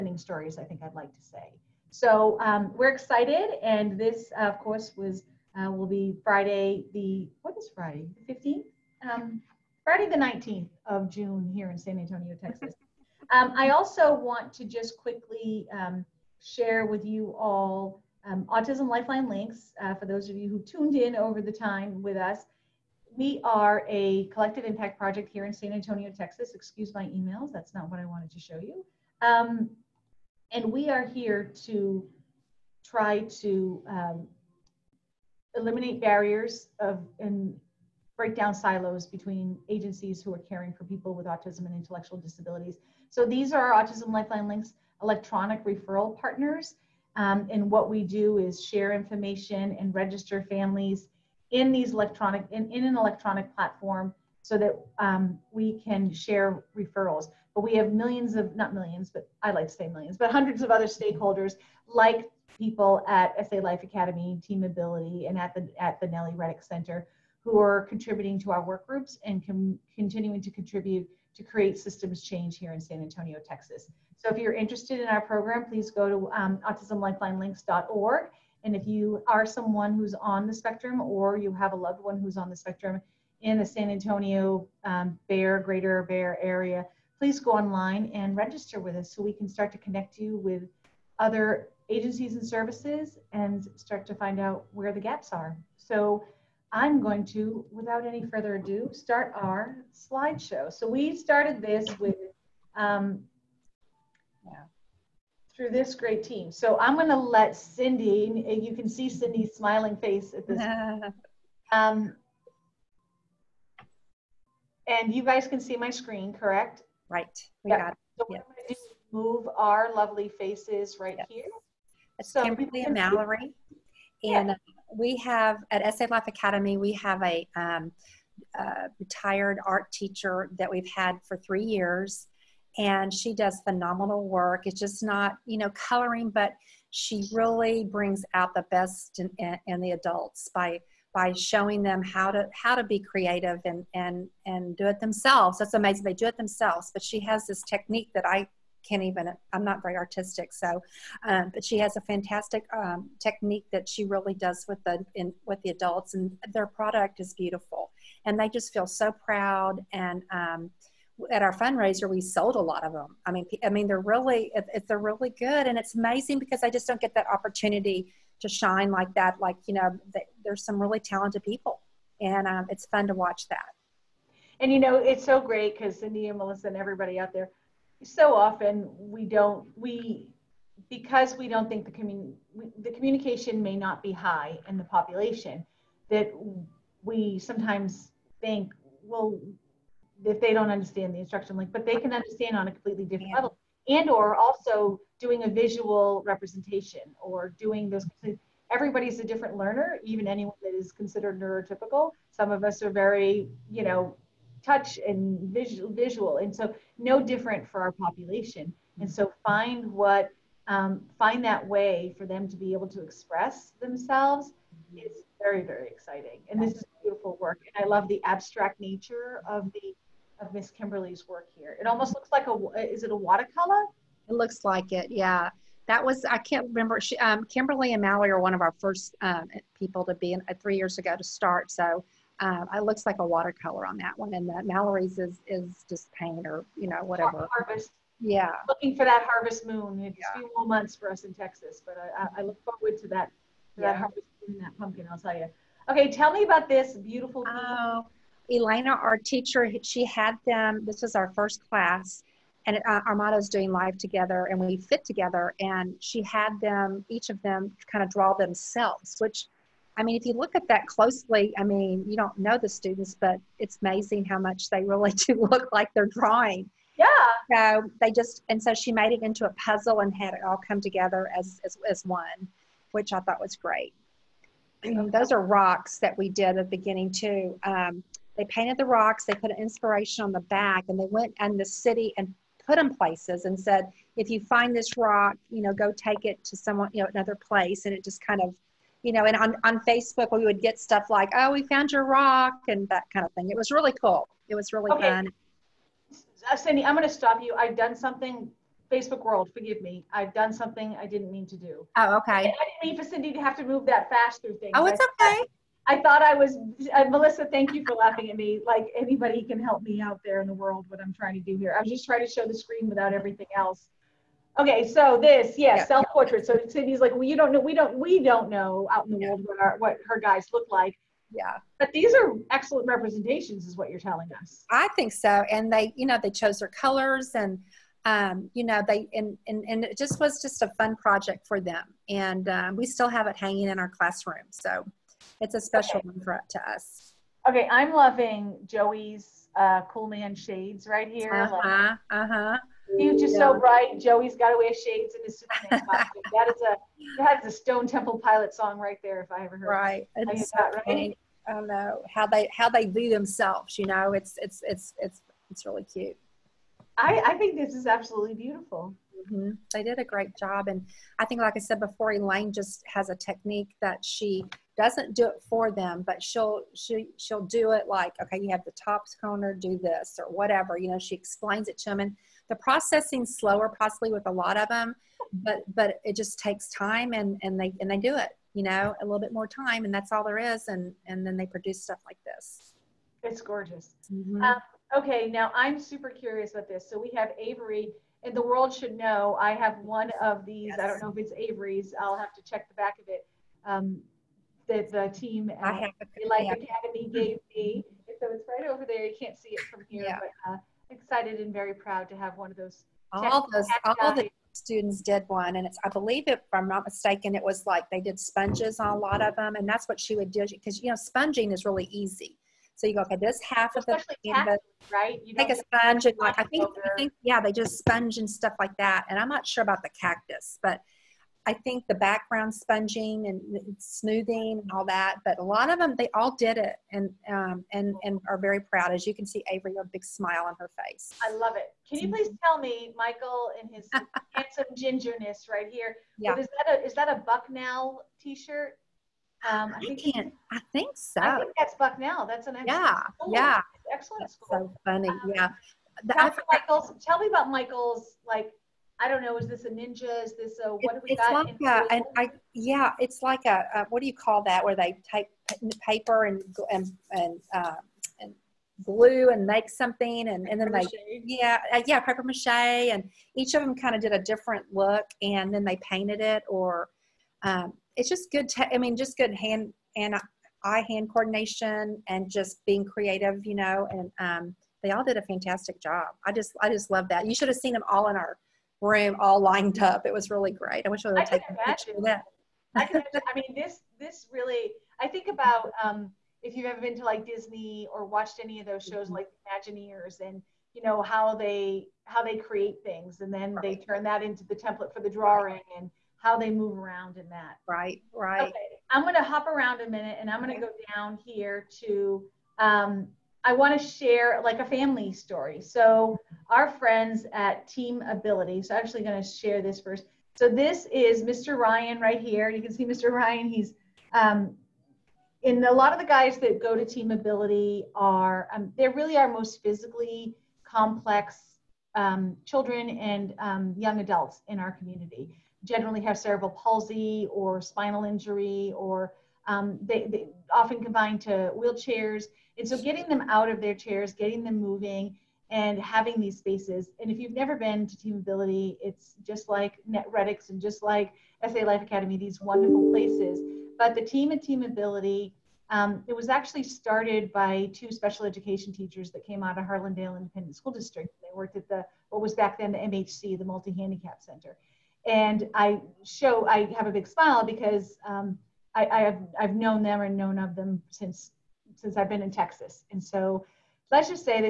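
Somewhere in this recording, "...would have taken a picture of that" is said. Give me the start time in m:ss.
8:01.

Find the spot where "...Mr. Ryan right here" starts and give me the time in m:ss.
8:31.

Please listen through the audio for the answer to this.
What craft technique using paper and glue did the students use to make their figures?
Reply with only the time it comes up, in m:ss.
7:41.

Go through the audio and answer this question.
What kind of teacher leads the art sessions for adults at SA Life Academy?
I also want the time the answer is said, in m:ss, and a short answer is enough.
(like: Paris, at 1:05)
Retired art teacher, at 2:08.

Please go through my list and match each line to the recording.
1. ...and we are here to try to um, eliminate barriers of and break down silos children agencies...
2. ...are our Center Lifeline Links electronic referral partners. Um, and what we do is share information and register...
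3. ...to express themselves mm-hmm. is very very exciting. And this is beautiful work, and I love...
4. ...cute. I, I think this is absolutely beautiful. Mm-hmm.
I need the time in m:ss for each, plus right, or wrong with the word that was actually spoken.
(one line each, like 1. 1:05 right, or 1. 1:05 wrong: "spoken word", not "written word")
1. 0:30 wrong: "between", not "children"
2. 0:43 wrong: "Autism", not "Center"
3. 3:32 right
4. 5:55 right.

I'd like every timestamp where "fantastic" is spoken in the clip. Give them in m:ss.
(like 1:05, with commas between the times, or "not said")
2:32, 7:55.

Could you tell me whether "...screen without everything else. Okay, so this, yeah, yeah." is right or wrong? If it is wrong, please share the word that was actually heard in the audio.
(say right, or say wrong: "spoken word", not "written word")
right.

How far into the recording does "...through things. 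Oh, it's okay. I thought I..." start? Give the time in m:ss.
5:04.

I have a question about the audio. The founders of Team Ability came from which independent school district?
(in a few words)
Harlandale.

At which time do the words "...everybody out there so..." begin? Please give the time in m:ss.
2:56.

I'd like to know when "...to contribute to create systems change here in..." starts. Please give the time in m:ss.
1:10.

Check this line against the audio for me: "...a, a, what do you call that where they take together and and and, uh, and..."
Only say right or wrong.
wrong.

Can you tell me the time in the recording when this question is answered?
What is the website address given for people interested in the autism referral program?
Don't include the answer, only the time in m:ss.
1:16.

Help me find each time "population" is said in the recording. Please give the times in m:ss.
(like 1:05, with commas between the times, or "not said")
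3:04, 3:27.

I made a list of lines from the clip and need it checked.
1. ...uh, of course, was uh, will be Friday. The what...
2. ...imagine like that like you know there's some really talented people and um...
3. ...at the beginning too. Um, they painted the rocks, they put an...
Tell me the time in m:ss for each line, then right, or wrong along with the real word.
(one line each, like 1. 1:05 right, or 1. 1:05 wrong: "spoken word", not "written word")
1. 0:04 right
2. 2:48 wrong: "shine", not "imagine"
3. 4:36 right.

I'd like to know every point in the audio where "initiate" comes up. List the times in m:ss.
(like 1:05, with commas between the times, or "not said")
not said.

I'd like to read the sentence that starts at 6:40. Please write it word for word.
but uh, excited and very proud to have one of those.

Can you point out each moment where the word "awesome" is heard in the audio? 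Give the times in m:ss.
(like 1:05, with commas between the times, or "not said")
not said.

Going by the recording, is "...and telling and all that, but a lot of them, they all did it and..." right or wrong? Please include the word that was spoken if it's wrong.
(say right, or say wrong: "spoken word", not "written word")
wrong: "smoothing", not "telling".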